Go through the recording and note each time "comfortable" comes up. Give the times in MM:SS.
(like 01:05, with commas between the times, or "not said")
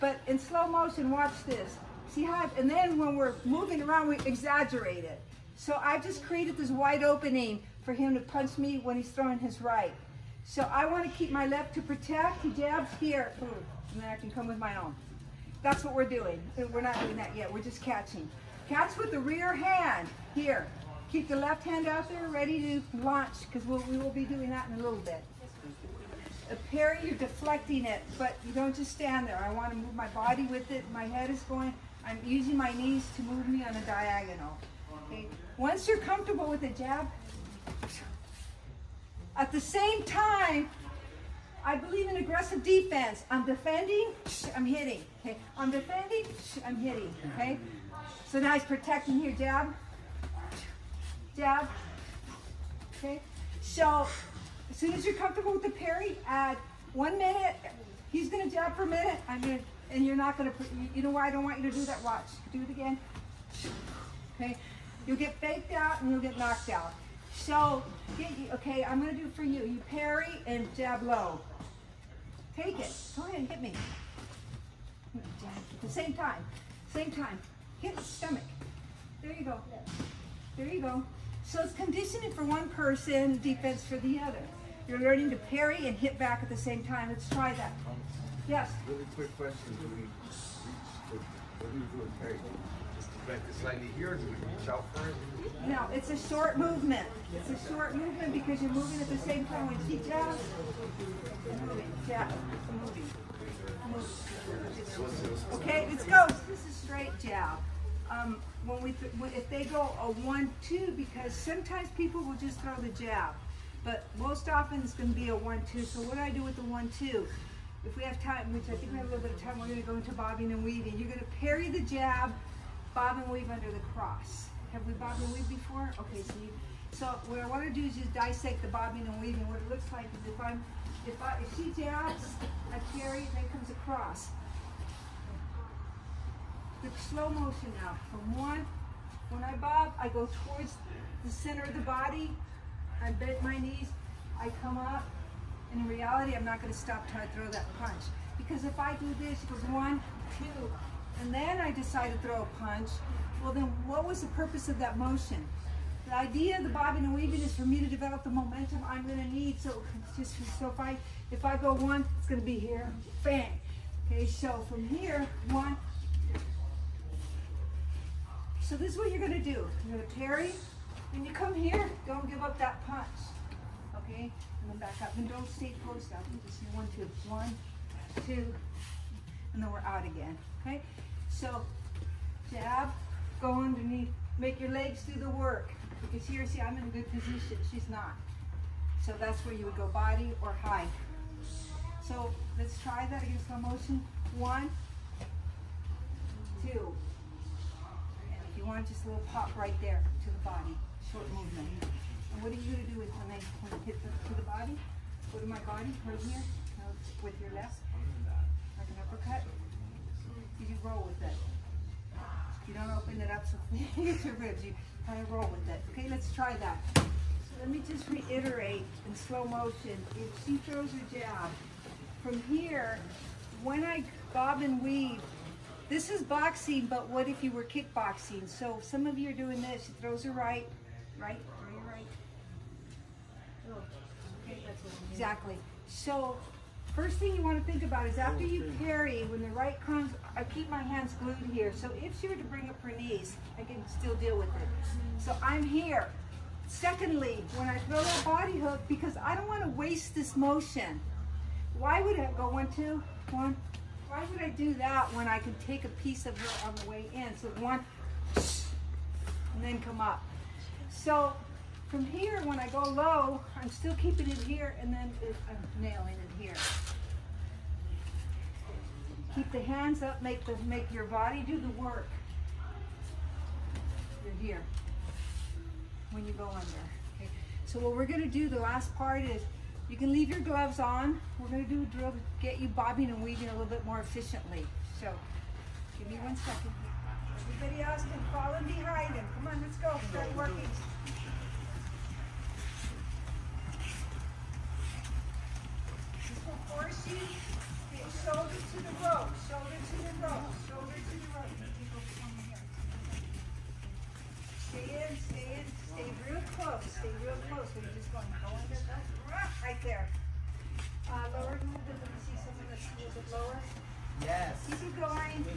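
00:35, 00:55.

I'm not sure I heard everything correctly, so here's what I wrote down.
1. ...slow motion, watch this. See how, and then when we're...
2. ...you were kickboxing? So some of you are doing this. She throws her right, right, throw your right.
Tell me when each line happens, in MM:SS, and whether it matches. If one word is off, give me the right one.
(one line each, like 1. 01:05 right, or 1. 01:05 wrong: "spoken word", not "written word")
1. 00:00 right
2. 03:47 right.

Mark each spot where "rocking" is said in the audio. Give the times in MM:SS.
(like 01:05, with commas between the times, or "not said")
not said.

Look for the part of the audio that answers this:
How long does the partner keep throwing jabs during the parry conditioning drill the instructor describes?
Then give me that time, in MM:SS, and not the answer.
00:56.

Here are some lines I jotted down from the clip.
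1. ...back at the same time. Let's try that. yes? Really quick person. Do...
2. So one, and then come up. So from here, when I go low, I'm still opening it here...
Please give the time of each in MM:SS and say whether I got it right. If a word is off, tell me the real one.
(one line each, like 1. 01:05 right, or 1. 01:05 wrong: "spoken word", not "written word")
1. 01:26 wrong: "question", not "person"
2. 04:17 wrong: "keeping", not "opening".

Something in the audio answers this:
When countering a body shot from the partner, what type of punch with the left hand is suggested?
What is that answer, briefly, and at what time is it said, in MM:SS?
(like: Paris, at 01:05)
uppercut, at 03:29.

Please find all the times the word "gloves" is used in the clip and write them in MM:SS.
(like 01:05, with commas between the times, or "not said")
04:40.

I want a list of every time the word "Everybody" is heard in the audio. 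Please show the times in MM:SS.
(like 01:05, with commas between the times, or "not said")
04:47.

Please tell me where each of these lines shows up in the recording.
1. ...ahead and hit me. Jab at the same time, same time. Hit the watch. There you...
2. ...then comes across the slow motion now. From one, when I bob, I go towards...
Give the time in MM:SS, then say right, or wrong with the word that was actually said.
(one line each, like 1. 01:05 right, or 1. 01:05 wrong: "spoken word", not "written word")
1. 01:13 wrong: "stomach", not "watch"
2. 02:13 right.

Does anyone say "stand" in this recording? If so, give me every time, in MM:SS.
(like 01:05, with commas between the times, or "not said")
00:28.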